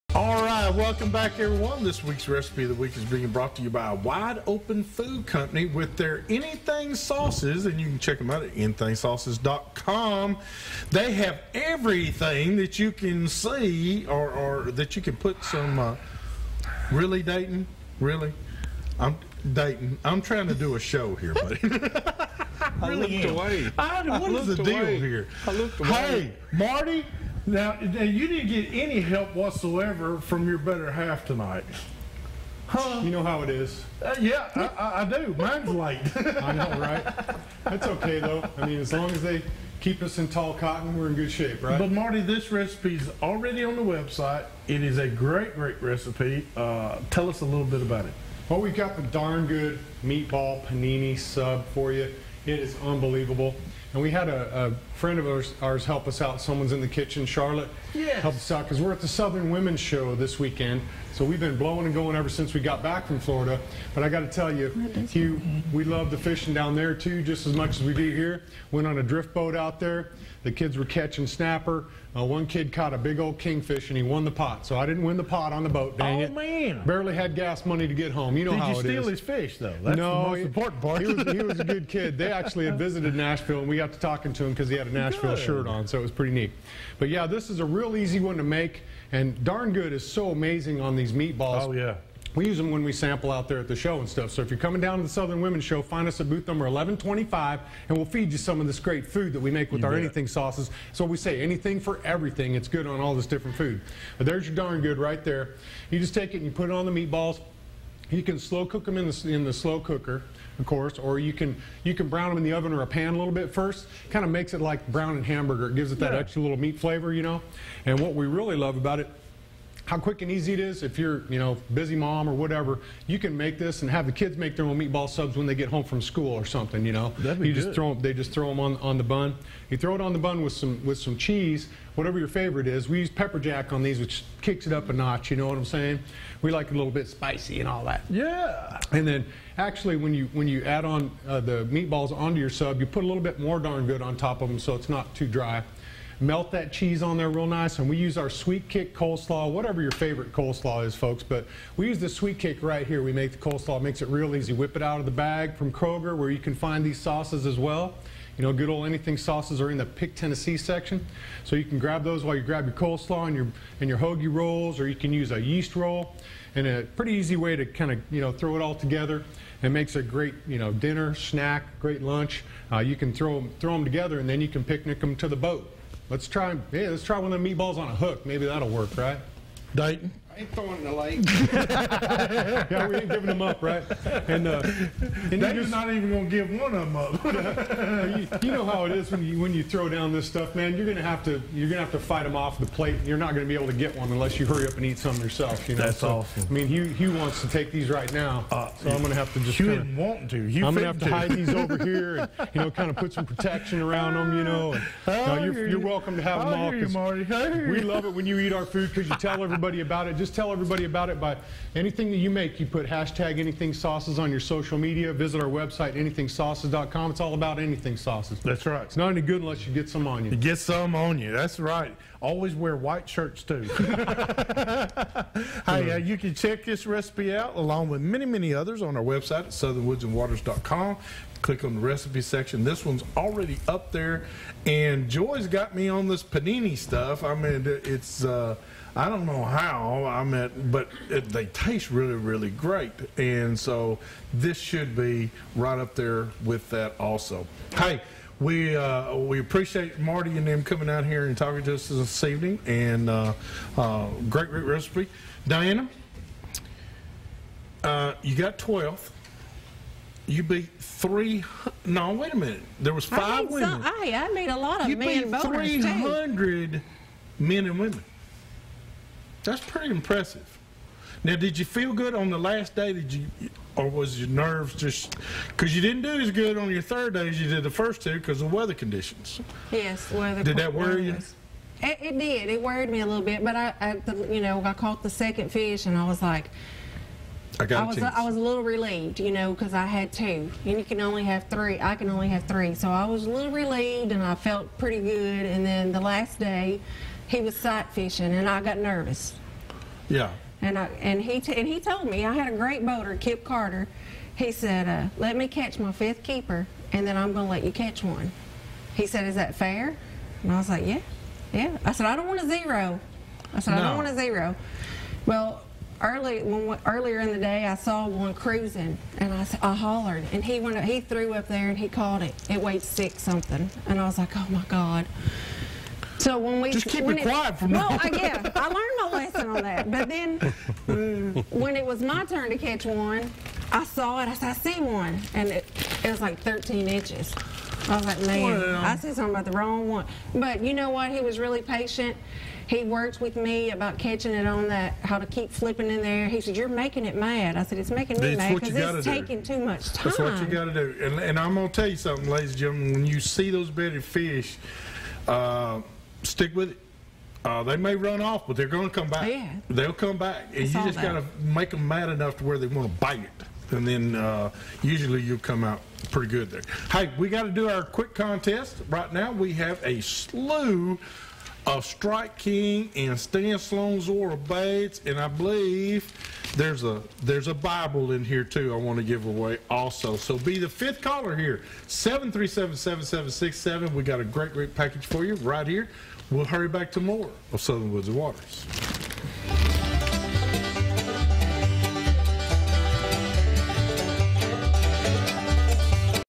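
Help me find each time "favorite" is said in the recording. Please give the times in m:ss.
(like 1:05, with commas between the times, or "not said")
2:12, 2:29.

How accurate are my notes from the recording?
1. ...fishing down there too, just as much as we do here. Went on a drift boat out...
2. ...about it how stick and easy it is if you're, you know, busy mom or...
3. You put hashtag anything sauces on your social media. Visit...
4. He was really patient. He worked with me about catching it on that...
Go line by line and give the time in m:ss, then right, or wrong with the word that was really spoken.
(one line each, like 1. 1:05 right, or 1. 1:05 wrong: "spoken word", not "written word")
1. 1:06 right
2. 1:58 wrong: "quick", not "stick"
3. 3:32 right
4. 5:41 right.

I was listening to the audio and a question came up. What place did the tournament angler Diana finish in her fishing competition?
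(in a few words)
12th.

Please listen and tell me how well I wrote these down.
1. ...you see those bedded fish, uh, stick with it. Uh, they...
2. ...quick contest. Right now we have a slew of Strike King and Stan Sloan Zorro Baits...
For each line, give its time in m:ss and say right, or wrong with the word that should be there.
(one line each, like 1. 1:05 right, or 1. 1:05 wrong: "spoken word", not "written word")
1. 5:53 right
2. 6:07 right.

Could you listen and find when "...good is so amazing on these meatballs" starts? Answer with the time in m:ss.
1:29.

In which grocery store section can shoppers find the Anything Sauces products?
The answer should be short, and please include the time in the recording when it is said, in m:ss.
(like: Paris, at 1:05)
Pick Tennessee section, at 2:39.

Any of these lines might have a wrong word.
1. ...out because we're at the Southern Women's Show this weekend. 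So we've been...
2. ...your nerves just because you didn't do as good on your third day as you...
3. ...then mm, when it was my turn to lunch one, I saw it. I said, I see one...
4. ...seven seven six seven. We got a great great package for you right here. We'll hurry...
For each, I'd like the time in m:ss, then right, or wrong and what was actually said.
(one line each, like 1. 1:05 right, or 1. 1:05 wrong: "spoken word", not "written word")
1. 0:58 right
2. 4:34 right
3. 5:30 wrong: "catch", not "lunch"
4. 6:22 right.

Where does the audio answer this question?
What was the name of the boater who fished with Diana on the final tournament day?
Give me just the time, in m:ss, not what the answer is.
5:03.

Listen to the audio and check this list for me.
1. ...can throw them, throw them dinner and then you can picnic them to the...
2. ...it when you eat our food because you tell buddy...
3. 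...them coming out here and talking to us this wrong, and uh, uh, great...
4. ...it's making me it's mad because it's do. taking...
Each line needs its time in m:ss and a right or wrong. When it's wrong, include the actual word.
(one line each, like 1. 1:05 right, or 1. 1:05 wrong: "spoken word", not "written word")
1. 2:52 wrong: "together", not "dinner"
2. 3:28 wrong: "everybody", not "buddy"
3. 4:10 wrong: "evening", not "wrong"
4. 5:47 right.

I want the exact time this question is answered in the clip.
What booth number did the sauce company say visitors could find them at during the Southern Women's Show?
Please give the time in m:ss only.
1:36.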